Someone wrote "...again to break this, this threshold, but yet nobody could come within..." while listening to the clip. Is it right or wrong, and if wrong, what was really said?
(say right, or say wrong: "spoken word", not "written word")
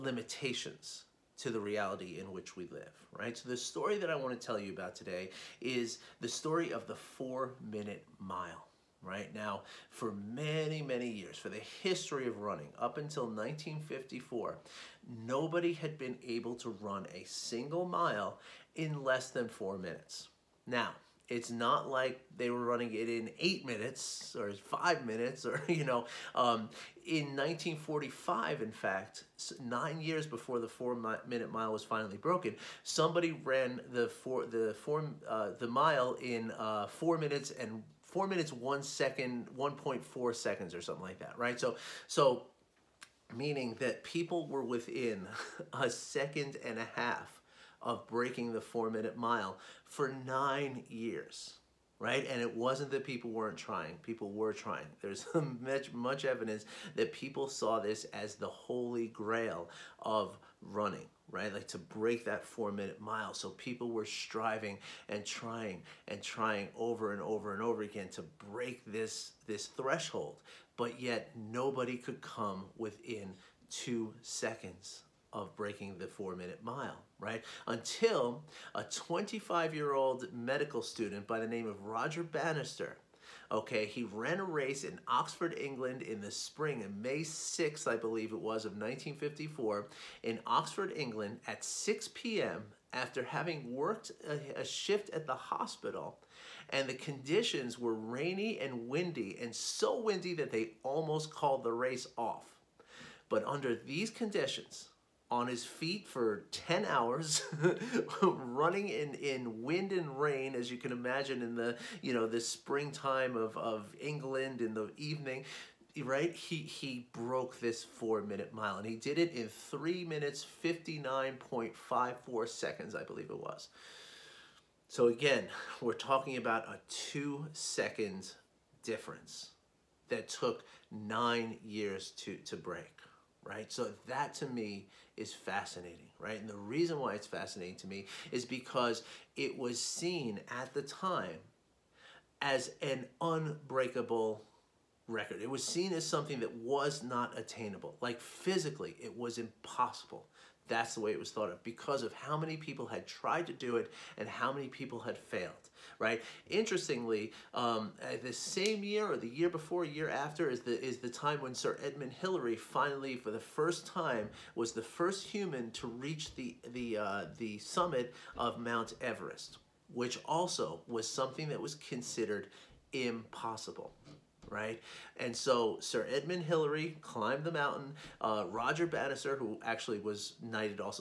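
right.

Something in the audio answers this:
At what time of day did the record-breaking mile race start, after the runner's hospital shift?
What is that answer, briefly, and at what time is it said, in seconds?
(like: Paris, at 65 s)
6 p.m., at 91 s.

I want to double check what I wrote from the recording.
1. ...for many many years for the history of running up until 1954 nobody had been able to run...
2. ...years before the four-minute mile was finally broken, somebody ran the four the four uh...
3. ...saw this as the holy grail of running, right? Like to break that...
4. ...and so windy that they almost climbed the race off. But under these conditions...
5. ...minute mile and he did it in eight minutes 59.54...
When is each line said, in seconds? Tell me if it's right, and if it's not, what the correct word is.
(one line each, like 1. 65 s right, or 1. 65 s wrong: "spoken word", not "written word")
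1. 9 s right
2. 29 s right
3. 57 s right
4. 99 s wrong: "called", not "climbed"
5. 118 s wrong: "three", not "eight".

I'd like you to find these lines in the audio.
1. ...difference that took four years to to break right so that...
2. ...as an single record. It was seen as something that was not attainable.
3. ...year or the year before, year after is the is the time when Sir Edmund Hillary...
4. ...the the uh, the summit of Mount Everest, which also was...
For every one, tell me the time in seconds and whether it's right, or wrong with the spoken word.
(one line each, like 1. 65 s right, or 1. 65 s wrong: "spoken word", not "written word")
1. 128 s wrong: "nine", not "four"
2. 142 s wrong: "unbreakable", not "single"
3. 158 s right
4. 166 s right.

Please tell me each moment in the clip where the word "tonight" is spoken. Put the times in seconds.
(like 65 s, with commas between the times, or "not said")
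not said.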